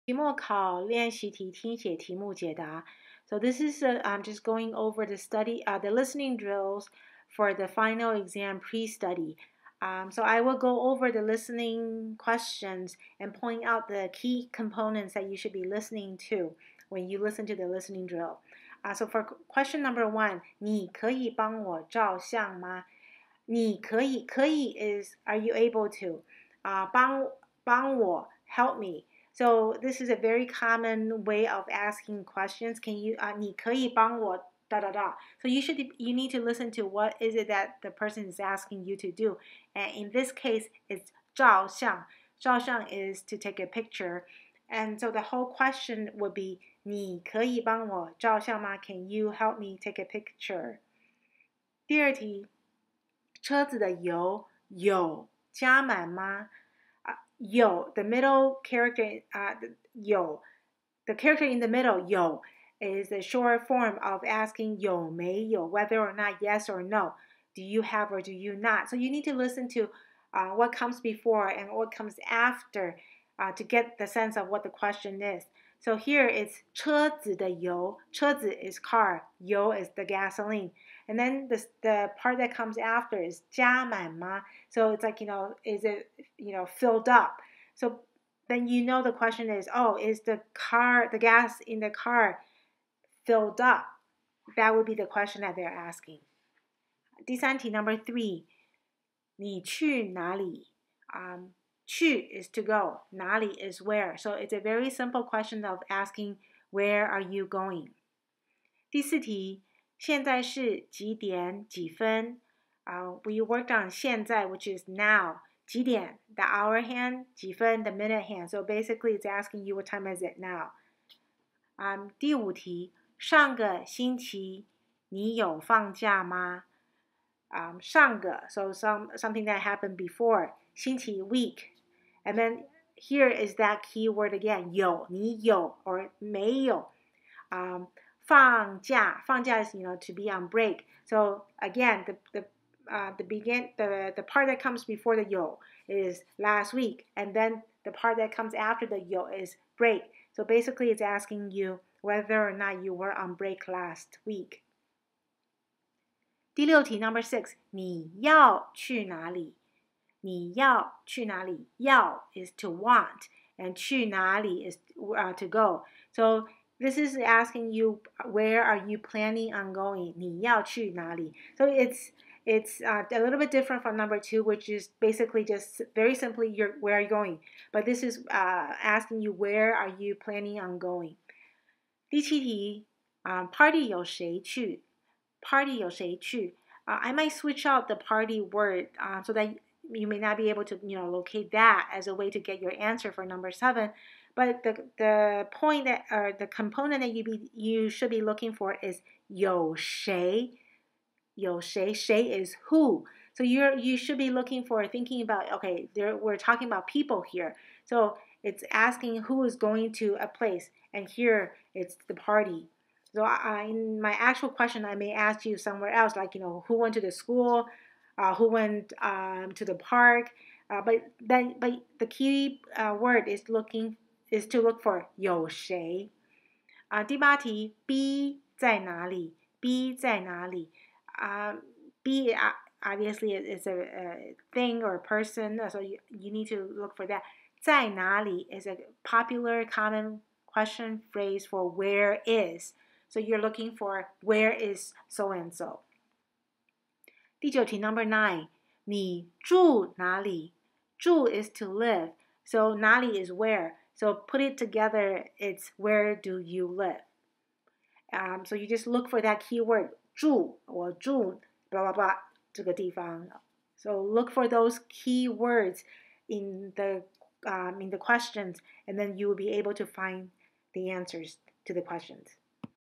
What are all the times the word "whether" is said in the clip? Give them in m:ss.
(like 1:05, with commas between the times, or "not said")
1:05, 2:32.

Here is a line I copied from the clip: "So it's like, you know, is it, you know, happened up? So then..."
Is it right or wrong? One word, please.
wrong.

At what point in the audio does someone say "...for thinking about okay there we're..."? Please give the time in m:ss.
3:24.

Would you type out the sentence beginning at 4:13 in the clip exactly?
So put it together, it's where do you live?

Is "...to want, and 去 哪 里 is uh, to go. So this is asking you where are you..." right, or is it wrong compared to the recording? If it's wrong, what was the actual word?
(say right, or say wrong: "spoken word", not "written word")
right.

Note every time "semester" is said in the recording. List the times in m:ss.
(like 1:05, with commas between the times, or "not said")
not said.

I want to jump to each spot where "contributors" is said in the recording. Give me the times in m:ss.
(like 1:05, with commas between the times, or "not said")
not said.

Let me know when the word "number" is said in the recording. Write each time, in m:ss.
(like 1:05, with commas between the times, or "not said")
0:19, 1:37, 2:36, 2:53, 3:13, 4:07.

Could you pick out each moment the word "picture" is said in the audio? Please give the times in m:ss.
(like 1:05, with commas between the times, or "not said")
0:43, 0:50.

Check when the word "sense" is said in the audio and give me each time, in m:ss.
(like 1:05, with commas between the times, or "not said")
1:14.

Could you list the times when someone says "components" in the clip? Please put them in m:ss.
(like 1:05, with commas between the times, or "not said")
0:14, 3:16.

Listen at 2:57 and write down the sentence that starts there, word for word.
But this is uh, asking you where are you planning on going?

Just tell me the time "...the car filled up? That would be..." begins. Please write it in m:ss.
1:31.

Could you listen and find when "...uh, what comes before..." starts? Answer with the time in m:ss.
1:10.